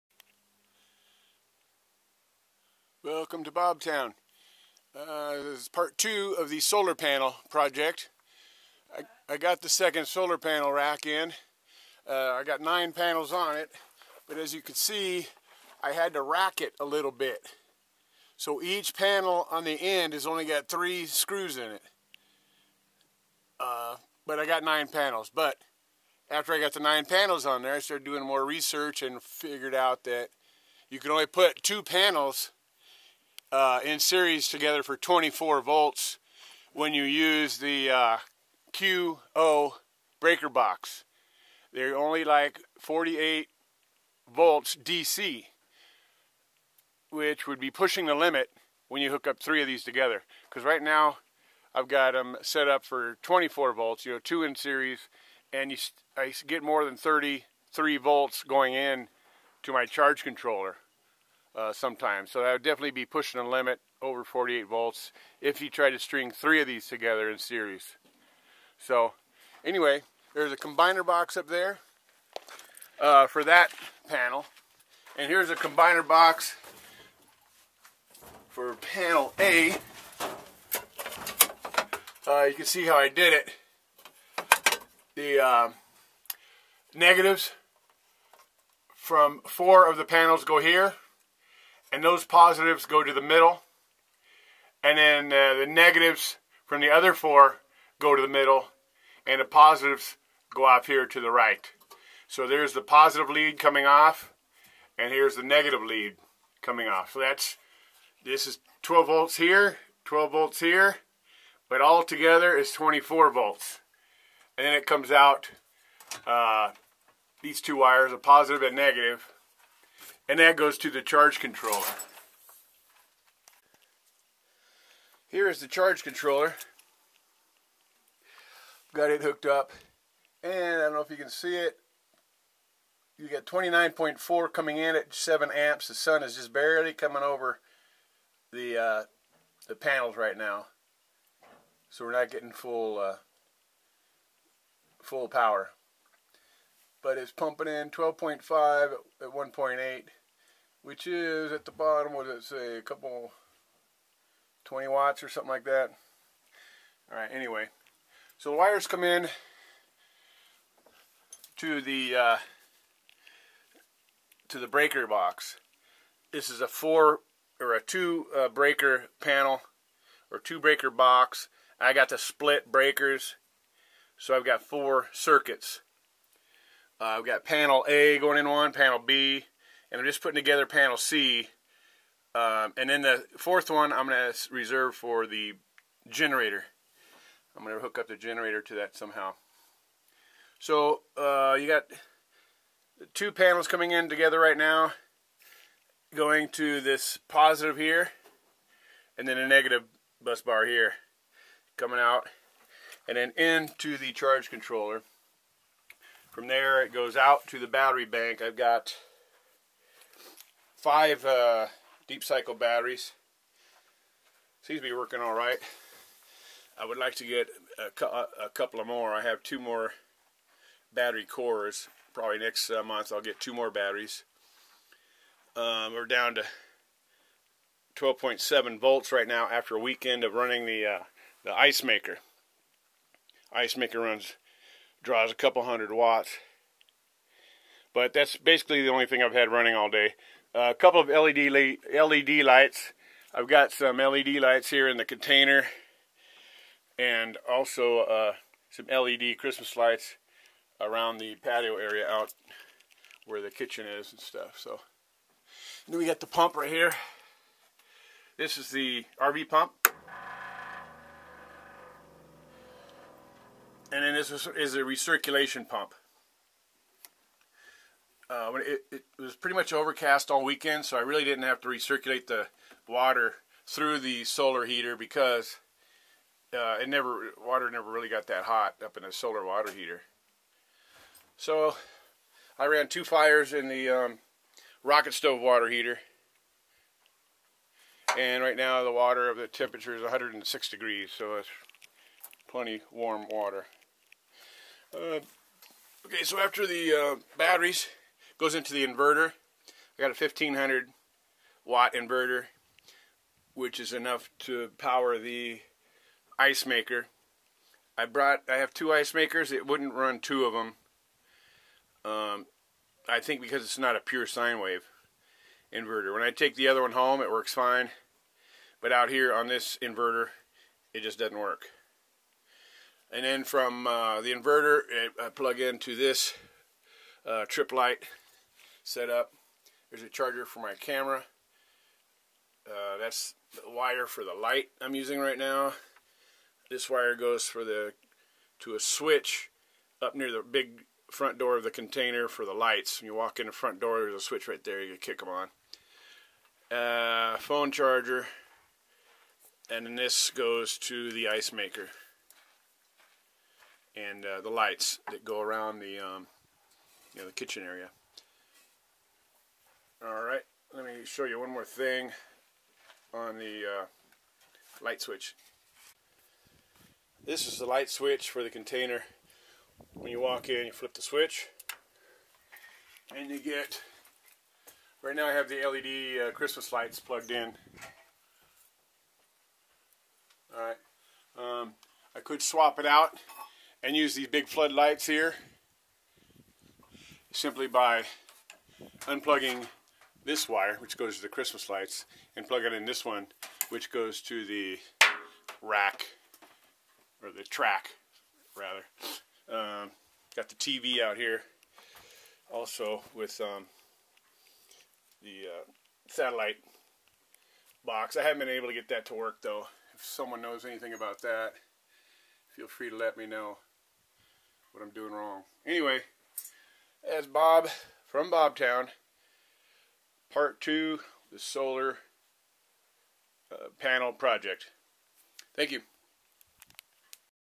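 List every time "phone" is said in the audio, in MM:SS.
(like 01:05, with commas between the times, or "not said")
05:47.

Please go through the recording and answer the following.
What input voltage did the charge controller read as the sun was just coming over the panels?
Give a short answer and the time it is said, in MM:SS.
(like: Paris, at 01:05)
29.4, at 02:13.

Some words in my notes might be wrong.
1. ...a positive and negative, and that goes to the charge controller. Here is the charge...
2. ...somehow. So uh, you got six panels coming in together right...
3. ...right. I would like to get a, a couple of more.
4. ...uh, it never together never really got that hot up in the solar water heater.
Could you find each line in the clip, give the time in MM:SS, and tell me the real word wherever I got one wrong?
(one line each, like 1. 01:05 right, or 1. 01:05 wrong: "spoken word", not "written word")
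1. 01:58 right
2. 03:08 wrong: "two", not "six"
3. 03:35 right
4. 04:36 wrong: "water", not "together".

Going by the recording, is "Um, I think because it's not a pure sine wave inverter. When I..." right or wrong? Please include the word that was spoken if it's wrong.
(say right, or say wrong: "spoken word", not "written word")
right.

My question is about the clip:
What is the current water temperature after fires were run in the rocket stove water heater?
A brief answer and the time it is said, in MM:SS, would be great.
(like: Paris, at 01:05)
106 degrees, at 04:50.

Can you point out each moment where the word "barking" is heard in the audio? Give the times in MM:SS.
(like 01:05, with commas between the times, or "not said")
not said.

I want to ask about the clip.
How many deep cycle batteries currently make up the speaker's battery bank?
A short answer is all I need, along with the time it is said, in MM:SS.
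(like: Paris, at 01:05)
5, at 03:30.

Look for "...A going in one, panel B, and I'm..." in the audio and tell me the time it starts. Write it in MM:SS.
02:57.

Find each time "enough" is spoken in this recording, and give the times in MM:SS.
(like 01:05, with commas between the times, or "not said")
05:03.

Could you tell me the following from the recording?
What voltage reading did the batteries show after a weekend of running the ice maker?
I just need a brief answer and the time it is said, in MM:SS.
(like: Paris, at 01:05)
12.7 volts, at 03:47.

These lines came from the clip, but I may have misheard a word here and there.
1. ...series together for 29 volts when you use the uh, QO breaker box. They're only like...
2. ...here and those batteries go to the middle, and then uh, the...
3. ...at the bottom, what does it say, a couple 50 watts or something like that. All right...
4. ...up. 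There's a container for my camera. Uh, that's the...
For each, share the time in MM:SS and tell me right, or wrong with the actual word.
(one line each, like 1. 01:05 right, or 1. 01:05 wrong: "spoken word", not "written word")
1. 00:33 wrong: "24", not "29"
2. 01:30 wrong: "positives", not "batteries"
3. 02:31 wrong: "20", not "50"
4. 05:29 wrong: "charger", not "container".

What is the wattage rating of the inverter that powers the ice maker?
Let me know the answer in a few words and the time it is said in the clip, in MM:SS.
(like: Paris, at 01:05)
1500 watts, at 05:00.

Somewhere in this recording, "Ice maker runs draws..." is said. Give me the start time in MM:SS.
03:53.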